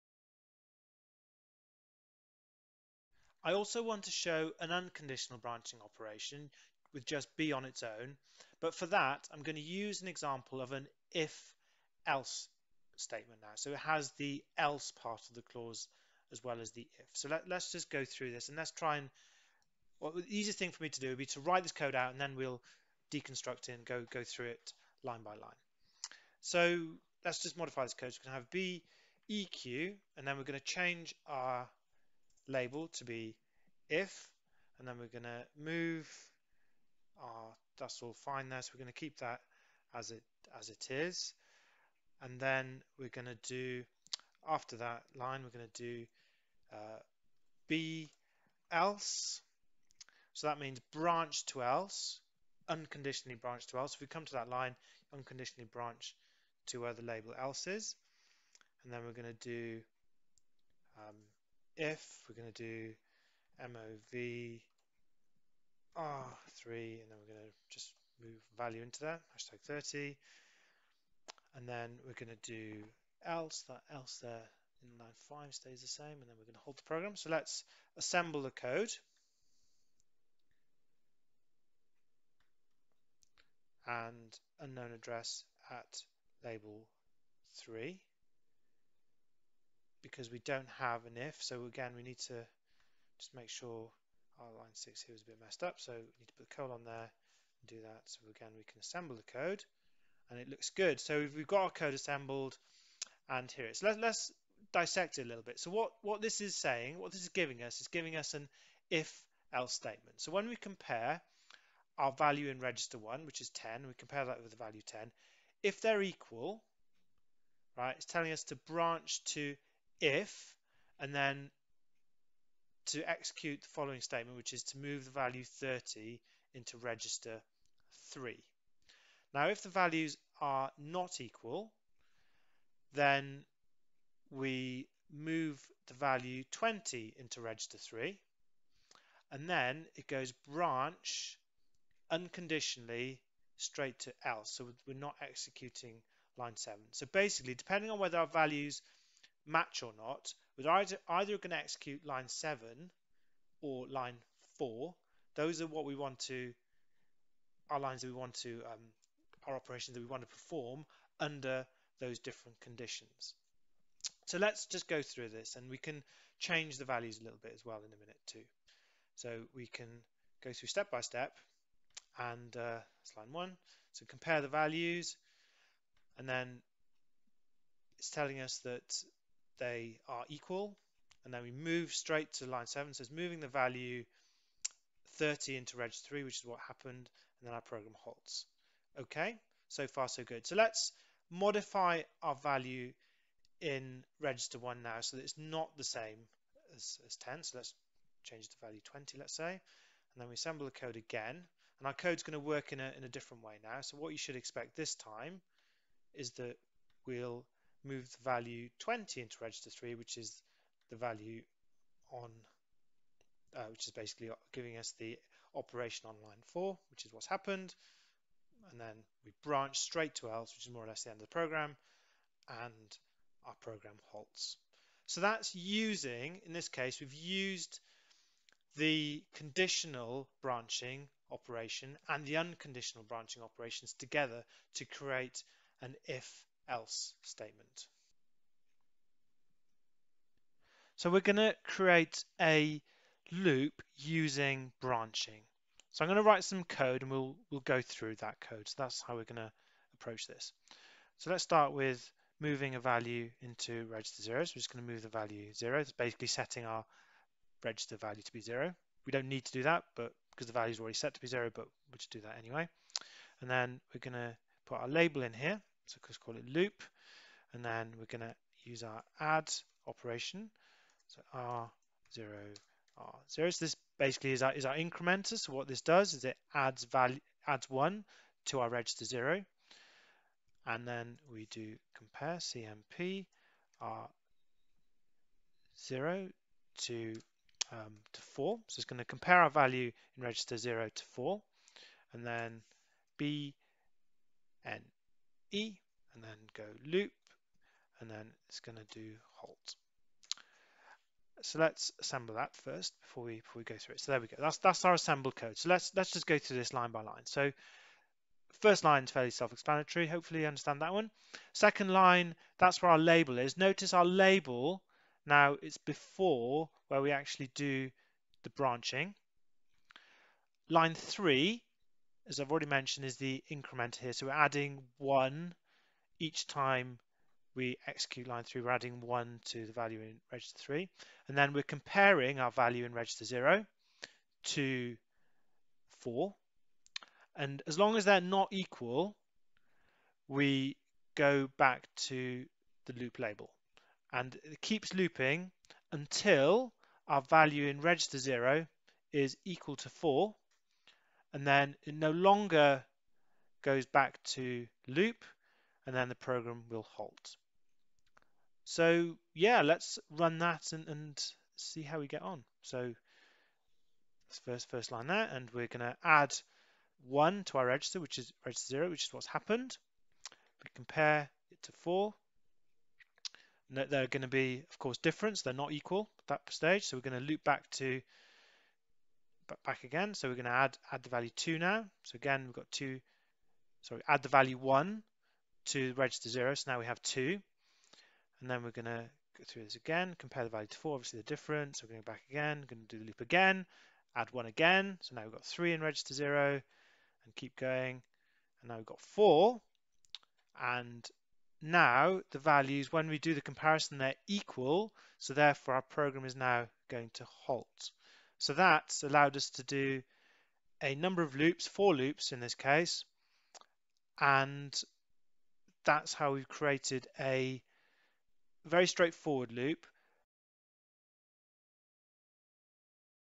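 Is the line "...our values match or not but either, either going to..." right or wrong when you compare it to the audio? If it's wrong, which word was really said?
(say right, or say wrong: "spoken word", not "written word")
right.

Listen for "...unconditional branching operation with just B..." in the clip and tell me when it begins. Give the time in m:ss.
0:04.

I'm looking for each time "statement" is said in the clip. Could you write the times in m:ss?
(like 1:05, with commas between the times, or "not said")
0:12, 1:49, 2:04, 3:57.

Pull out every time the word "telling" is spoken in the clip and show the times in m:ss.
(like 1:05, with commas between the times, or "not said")
1:58, 2:58.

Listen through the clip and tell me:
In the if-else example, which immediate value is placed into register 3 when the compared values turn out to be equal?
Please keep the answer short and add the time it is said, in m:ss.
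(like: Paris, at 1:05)
30, at 1:09.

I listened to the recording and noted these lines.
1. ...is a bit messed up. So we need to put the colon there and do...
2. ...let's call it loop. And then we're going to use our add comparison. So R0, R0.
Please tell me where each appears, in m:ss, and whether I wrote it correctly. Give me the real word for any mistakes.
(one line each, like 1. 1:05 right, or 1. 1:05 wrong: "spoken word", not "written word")
1. 1:35 right
2. 4:26 wrong: "operation", not "comparison".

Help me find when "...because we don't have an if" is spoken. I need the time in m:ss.
1:30.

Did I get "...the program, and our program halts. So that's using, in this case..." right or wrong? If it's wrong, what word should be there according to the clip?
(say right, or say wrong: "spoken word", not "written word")
right.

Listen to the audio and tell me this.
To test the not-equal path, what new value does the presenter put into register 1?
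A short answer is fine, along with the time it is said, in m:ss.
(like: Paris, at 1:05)
20, at 3:18.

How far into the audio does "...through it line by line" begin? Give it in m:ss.
0:24.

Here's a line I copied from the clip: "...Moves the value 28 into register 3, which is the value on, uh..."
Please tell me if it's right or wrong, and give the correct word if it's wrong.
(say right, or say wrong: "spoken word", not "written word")
wrong: "20", not "28".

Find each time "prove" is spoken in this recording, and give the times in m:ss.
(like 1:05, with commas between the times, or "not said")
not said.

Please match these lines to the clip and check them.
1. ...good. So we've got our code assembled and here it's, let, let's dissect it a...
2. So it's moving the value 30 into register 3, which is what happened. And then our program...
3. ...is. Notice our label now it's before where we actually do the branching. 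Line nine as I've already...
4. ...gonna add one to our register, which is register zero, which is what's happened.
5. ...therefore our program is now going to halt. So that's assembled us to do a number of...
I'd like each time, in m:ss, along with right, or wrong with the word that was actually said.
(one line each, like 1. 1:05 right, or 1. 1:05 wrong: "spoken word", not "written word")
1. 1:40 right
2. 3:02 right
3. 5:13 wrong: "three", not "nine"
4. 6:05 right
5. 6:45 wrong: "allowed", not "assembled".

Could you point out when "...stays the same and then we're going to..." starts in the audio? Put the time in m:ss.
1:15.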